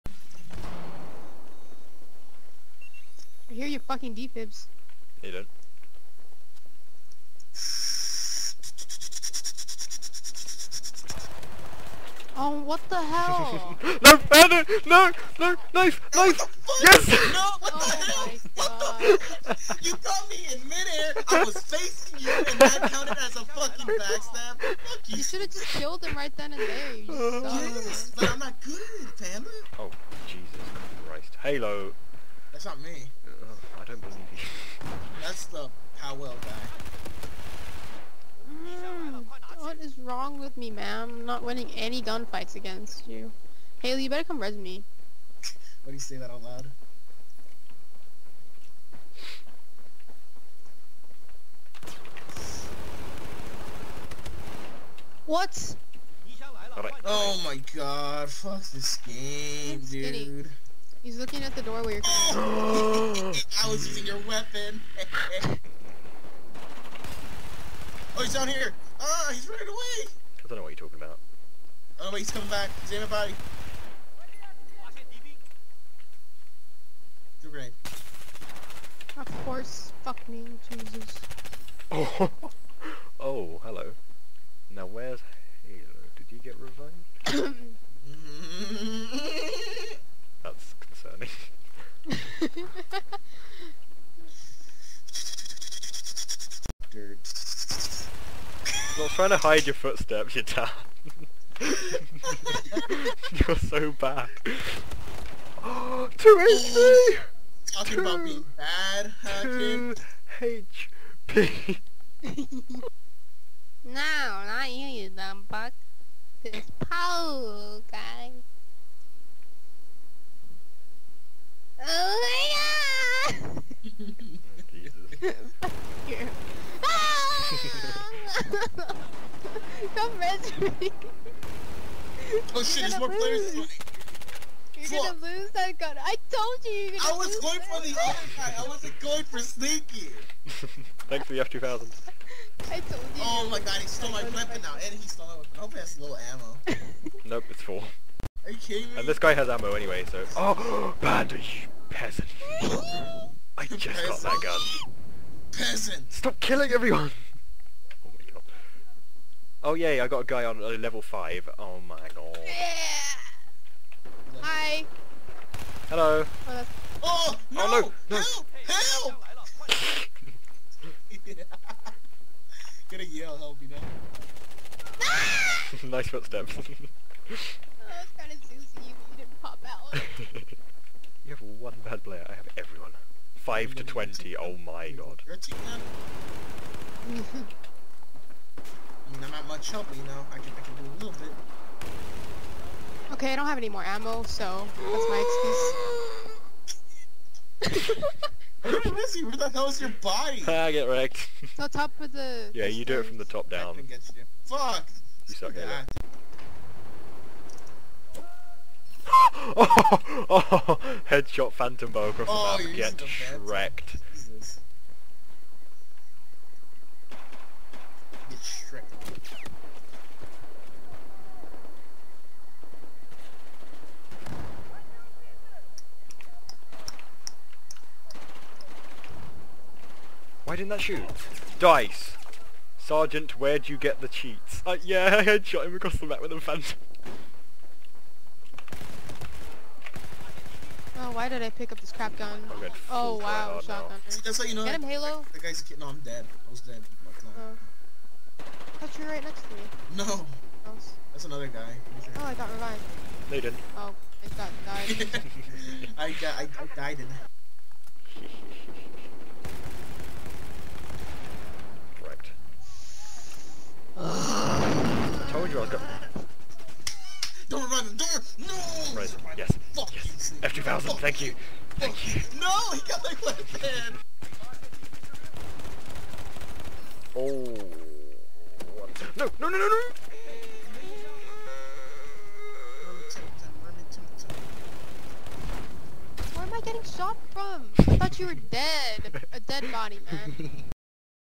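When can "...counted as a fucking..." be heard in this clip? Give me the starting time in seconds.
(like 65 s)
22 s.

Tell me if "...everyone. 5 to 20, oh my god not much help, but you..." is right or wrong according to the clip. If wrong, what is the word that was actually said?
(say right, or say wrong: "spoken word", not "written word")
right.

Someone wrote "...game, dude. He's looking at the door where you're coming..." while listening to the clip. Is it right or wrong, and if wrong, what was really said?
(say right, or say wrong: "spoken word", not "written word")
right.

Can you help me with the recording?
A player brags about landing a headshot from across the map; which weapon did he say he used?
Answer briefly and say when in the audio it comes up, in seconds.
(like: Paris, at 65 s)
phantom bow, at 211 s.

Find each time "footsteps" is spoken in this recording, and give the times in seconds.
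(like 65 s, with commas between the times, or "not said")
99 s, 176 s.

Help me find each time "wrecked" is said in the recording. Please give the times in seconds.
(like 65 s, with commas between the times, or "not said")
200 s, 213 s.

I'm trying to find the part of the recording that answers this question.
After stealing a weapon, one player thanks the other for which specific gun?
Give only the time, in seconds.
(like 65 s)
141 s.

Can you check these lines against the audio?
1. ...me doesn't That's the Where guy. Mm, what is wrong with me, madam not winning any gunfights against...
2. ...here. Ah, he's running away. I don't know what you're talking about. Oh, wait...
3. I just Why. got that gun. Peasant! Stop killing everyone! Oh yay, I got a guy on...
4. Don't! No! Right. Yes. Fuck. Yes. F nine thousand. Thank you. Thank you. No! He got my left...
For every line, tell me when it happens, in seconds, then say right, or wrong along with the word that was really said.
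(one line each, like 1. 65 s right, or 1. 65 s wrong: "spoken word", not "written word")
1. 32 s wrong: "Powell", not "Where"
2. 68 s right
3. 153 s wrong: "Peasant", not "Why"
4. 267 s wrong: "two", not "nine".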